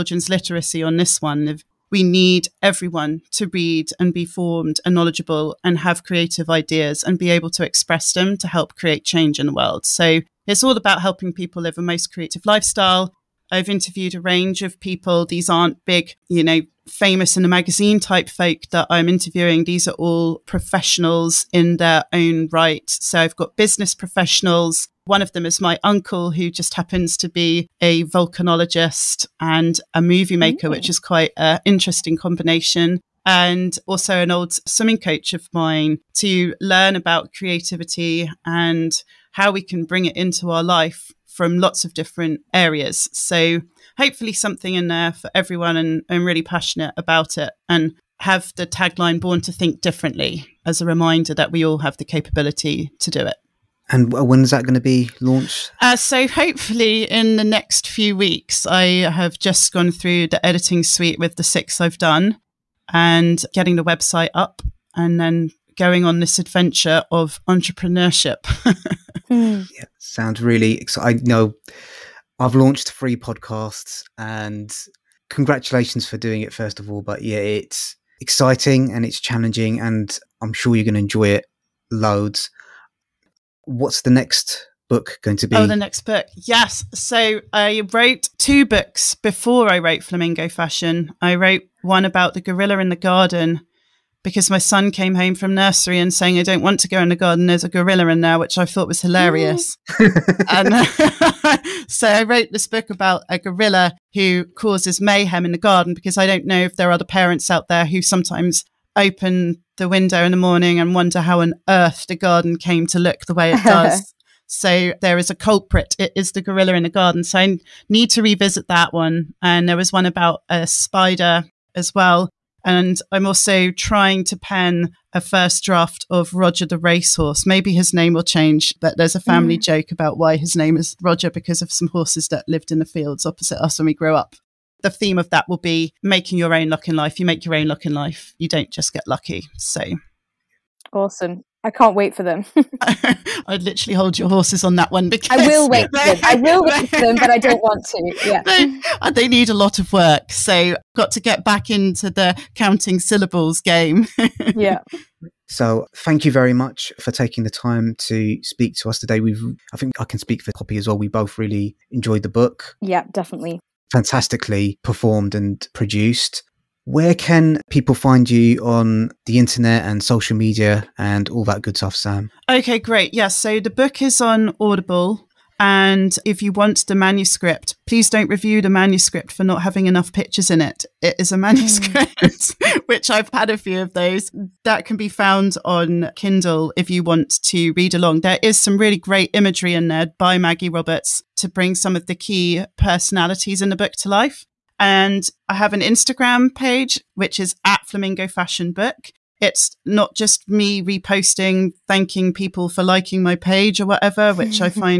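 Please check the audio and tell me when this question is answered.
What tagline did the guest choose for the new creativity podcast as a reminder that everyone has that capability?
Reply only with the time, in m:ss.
0:49.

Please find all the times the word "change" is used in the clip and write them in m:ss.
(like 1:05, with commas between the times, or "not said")
0:09, 2:08.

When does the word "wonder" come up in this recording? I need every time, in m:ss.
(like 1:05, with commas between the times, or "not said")
1:50.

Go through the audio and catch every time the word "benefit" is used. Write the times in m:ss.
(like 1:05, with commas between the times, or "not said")
not said.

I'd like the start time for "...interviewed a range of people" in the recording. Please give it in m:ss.
0:13.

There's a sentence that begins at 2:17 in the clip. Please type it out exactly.
You make your own luck in life, you don't just get lucky.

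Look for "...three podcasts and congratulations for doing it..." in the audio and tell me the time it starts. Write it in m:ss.
1:12.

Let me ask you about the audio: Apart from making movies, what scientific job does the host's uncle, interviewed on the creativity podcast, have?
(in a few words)
Volcanologist.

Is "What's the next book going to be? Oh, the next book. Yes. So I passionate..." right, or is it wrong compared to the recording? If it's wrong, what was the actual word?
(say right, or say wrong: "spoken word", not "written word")
wrong: "wrote", not "passionate".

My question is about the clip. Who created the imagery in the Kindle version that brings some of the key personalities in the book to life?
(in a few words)
Maggie Roberts.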